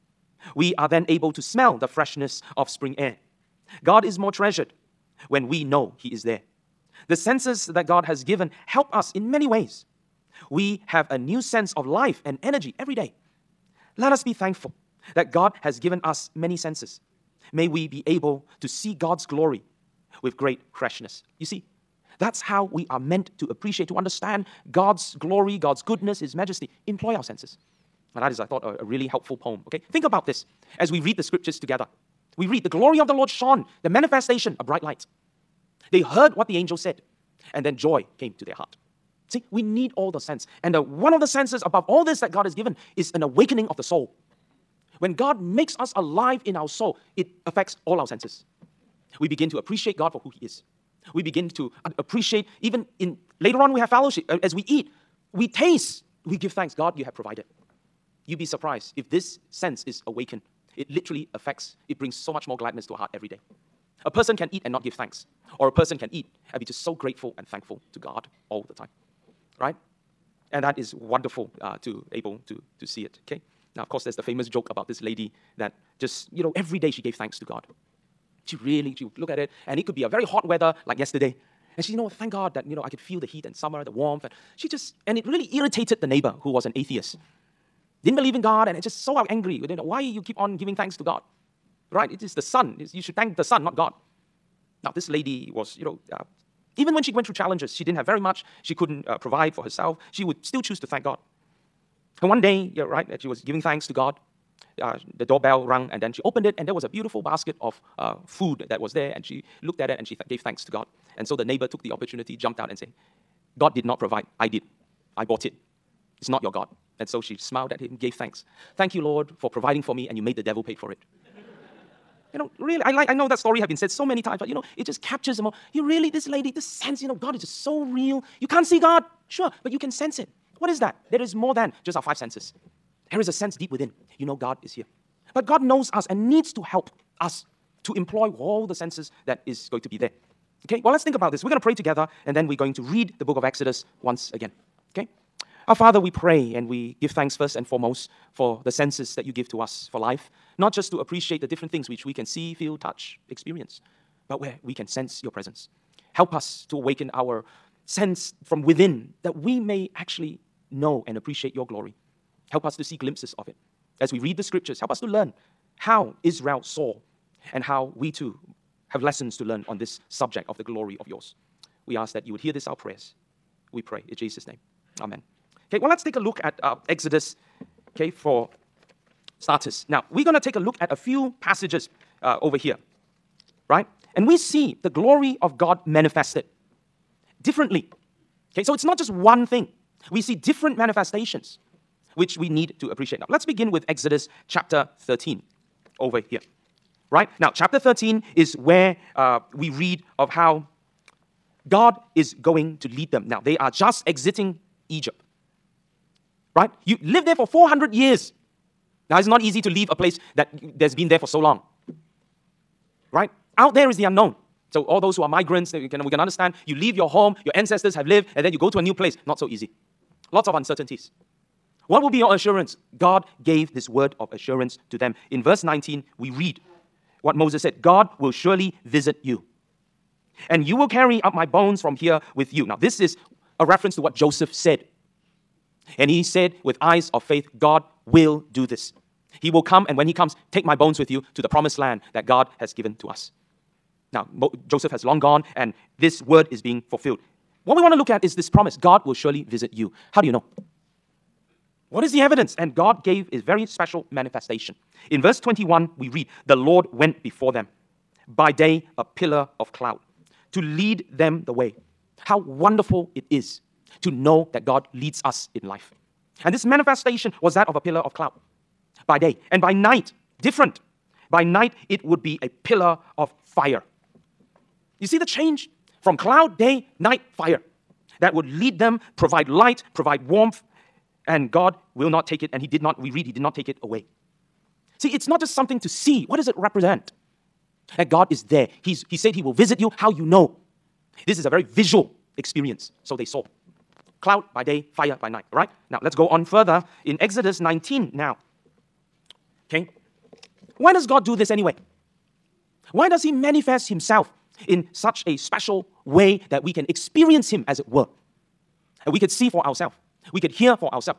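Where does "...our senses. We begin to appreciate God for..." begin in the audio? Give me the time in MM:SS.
00:47.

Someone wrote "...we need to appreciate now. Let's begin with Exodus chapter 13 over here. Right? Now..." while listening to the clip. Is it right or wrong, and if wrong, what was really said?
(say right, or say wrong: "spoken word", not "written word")
right.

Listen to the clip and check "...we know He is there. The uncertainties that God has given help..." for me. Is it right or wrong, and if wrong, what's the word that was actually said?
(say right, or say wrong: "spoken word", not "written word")
wrong: "senses", not "uncertainties".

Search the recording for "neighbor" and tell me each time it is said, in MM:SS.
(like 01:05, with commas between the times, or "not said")
01:26, 01:51.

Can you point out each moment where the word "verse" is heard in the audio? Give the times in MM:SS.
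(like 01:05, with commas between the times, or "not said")
03:45, 04:15.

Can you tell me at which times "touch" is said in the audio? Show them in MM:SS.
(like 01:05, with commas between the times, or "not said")
02:32.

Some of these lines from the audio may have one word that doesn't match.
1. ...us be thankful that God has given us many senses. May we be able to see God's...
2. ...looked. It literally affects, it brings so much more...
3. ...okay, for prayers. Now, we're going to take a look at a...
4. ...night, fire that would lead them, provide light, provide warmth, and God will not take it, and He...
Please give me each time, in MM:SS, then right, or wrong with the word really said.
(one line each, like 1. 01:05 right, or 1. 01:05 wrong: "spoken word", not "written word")
1. 00:14 right
2. 01:00 wrong: "awakened", not "looked"
3. 02:57 wrong: "starters", not "prayers"
4. 04:36 right.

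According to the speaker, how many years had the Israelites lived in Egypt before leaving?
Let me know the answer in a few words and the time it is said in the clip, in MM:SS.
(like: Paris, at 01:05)
400 years, at 03:27.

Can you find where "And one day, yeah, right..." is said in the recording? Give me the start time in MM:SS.
01:42.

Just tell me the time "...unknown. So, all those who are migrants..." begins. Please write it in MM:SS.
03:34.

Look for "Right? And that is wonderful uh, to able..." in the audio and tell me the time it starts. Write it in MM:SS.
01:09.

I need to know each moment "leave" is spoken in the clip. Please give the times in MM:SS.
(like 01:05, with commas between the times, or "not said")
03:29, 03:36.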